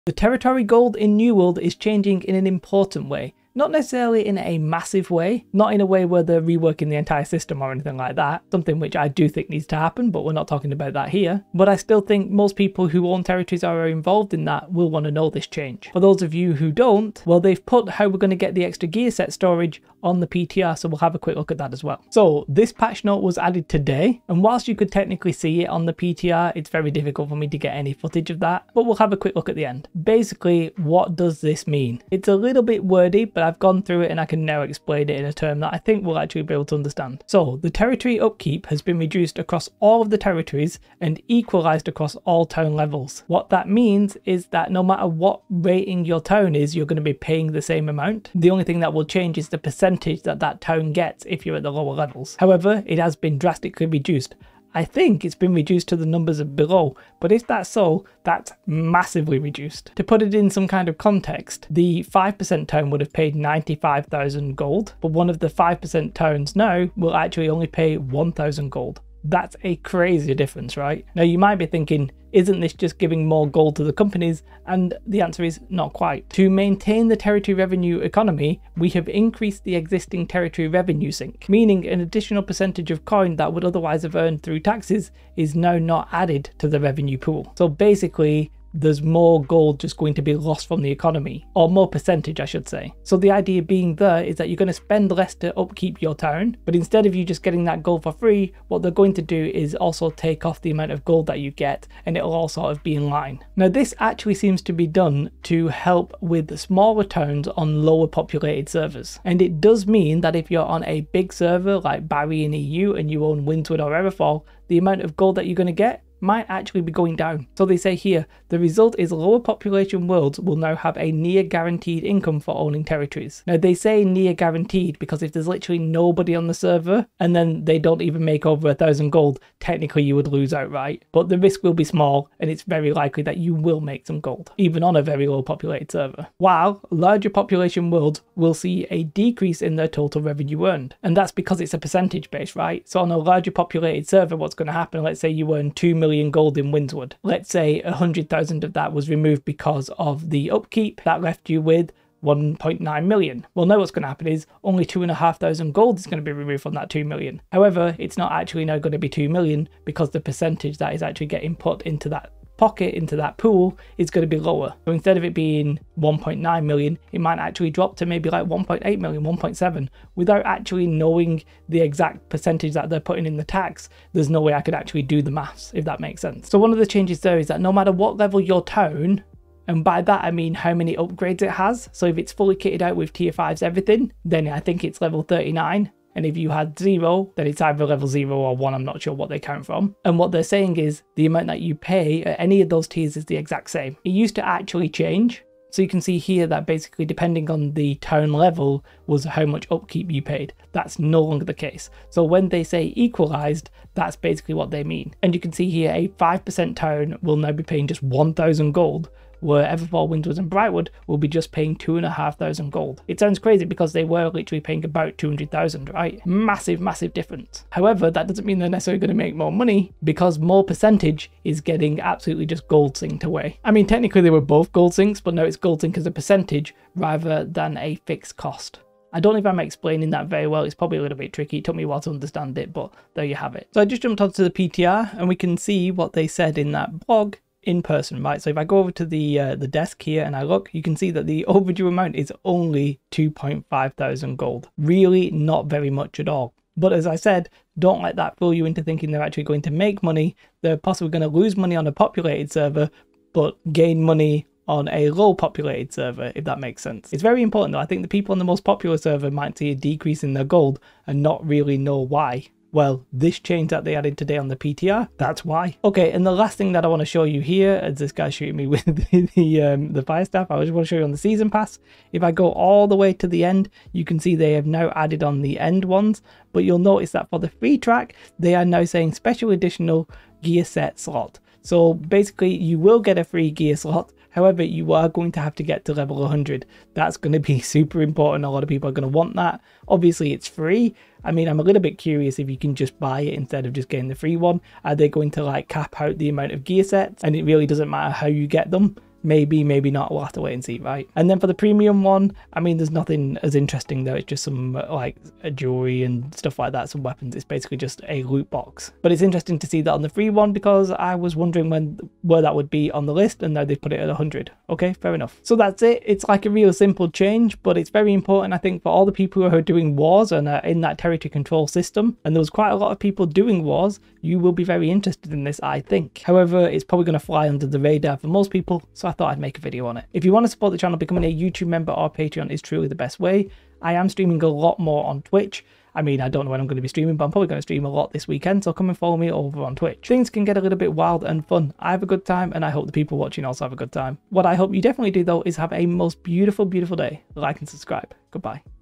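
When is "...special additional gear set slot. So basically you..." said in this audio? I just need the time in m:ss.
4:39.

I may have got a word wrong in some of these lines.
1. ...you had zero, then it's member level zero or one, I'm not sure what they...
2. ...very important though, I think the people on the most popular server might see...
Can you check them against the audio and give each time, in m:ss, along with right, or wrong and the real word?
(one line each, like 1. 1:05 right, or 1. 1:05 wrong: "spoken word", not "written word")
1. 3:06 wrong: "either", not "member"
2. 4:17 right.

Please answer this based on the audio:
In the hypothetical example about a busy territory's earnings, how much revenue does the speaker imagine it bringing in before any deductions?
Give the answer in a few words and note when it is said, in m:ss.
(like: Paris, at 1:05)
2 million gold, at 2:25.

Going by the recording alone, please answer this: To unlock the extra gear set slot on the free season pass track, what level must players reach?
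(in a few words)
100.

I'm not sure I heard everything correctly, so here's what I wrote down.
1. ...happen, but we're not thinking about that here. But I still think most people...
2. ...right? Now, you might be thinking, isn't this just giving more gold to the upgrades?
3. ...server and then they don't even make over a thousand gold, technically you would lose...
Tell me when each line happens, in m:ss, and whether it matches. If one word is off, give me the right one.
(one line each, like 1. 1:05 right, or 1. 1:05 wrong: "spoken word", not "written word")
1. 0:09 wrong: "talking", not "thinking"
2. 1:10 wrong: "companies", not "upgrades"
3. 2:06 right.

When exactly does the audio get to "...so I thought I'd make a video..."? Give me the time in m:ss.
5:28.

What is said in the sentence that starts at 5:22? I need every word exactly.
And there was quite a lot of people doing wars.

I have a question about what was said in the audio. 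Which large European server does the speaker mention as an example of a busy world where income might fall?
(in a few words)
Barry.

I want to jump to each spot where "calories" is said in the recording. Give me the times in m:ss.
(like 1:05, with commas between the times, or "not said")
not said.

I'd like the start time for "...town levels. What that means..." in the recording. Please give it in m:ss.
0:42.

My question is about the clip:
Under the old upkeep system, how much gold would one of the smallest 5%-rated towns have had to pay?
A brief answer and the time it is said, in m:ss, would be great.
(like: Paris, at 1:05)
95,000 gold, at 1:03.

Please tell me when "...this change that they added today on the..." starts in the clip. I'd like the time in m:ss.
4:23.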